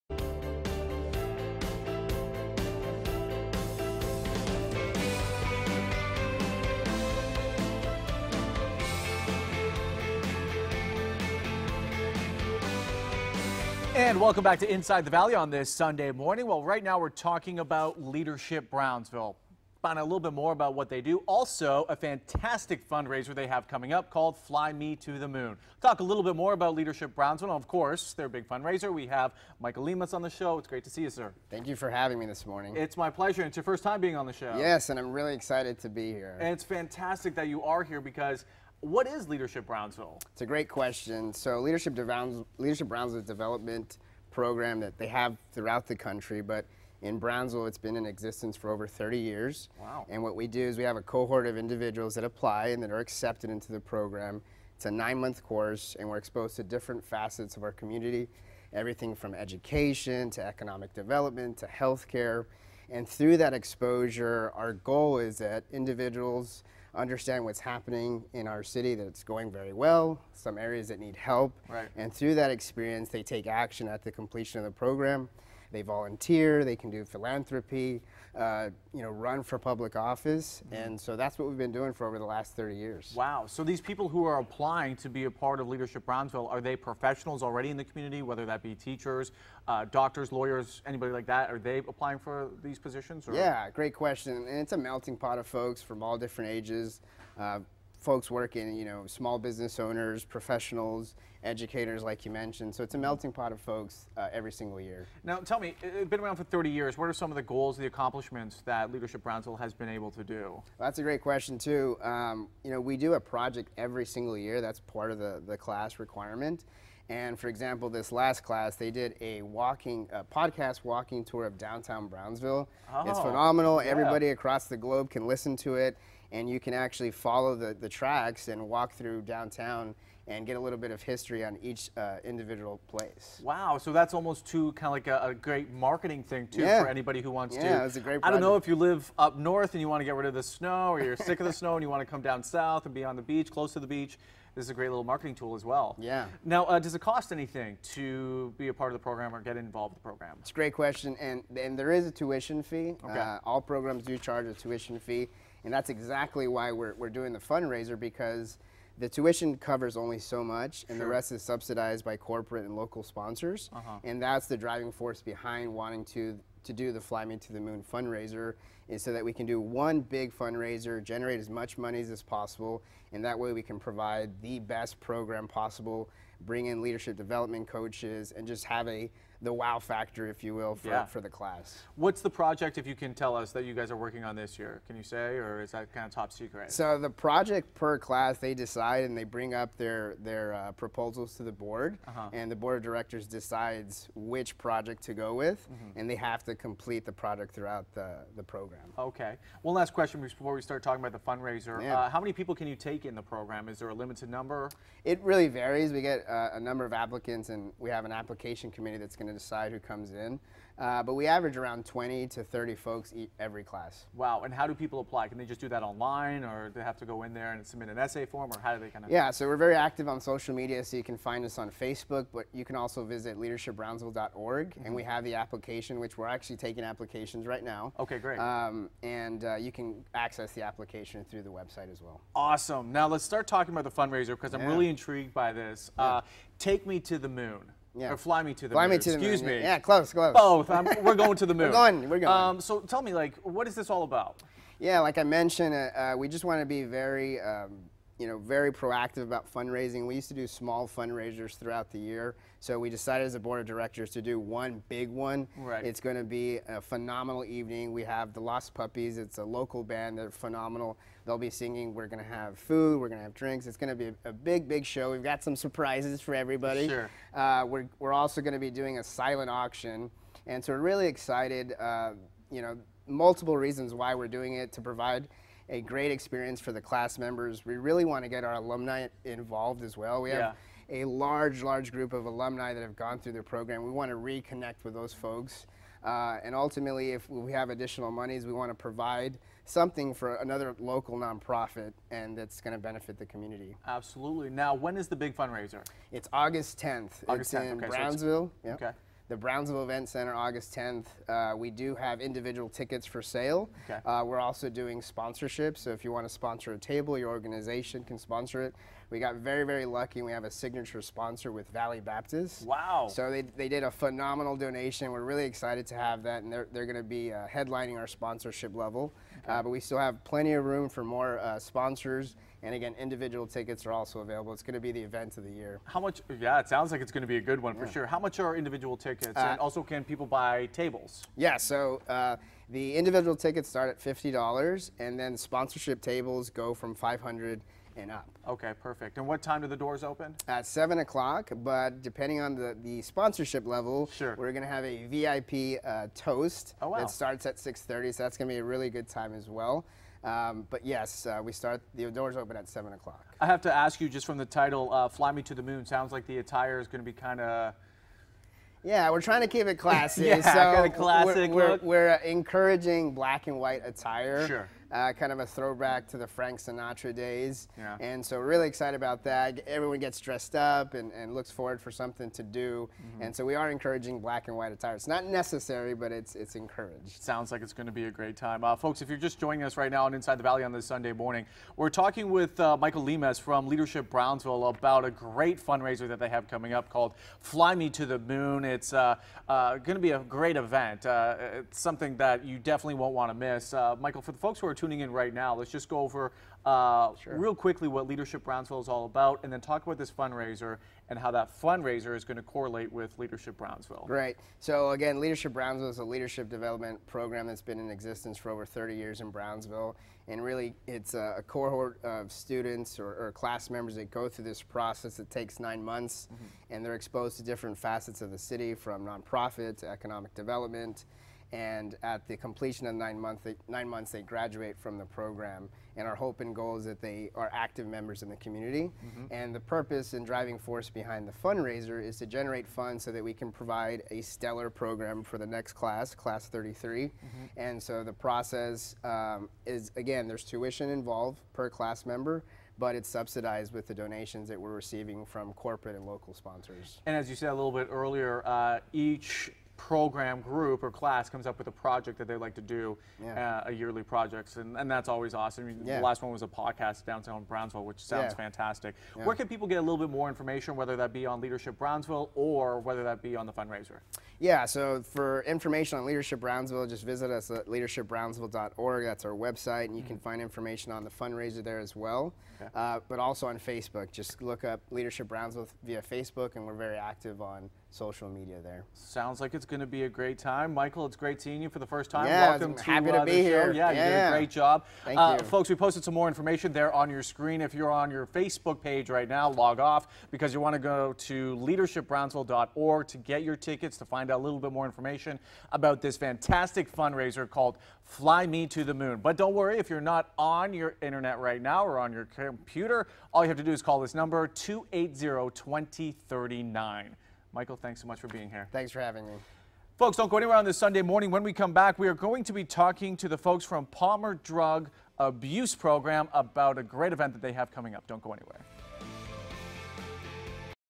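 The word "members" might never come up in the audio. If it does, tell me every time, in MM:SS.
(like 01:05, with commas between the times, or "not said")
04:37, 06:53, 07:07, 07:22.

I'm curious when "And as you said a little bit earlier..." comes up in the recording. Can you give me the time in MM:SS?
07:27.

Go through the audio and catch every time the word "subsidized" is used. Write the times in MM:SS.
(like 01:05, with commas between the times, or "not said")
02:41, 07:23.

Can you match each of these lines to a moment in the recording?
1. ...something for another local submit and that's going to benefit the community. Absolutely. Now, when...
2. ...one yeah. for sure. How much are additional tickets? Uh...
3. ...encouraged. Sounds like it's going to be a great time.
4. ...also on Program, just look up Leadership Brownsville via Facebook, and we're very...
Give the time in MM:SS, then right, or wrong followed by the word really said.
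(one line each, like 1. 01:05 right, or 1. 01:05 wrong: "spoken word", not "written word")
1. 04:49 wrong: "nonprofit", not "submit"
2. 05:27 wrong: "individual", not "additional"
3. 06:16 right
4. 07:53 wrong: "Facebook", not "Program".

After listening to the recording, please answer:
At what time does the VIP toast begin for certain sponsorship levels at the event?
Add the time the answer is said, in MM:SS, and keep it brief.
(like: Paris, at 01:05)
6:30, at 05:47.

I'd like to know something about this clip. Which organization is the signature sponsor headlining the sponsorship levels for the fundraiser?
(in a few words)
Valley Baptist.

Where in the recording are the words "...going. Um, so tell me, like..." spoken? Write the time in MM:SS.
04:02.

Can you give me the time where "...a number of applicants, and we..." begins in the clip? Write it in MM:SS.
03:26.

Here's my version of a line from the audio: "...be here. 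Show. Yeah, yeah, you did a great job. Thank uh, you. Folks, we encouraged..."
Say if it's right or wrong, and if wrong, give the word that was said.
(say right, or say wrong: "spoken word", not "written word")
wrong: "posted", not "encouraged".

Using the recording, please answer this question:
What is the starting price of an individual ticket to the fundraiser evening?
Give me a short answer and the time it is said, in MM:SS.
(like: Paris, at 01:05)
$50, at 05:33.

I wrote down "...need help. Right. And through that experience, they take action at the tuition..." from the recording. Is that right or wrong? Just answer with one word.
wrong.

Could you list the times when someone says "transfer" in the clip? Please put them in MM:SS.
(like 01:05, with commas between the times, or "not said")
not said.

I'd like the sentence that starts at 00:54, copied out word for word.
It's a nine month course, and we're exposed to different facets of our community everything from education to economic development to healthcare.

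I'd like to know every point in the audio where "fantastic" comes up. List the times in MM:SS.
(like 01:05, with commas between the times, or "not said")
00:21, 00:36, 07:38, 08:16.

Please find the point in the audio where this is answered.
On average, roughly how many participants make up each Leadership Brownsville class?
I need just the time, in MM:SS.
03:31.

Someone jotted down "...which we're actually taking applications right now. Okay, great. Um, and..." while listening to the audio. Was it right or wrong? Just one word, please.
right.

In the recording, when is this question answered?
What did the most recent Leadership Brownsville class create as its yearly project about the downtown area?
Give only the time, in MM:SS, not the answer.
02:00.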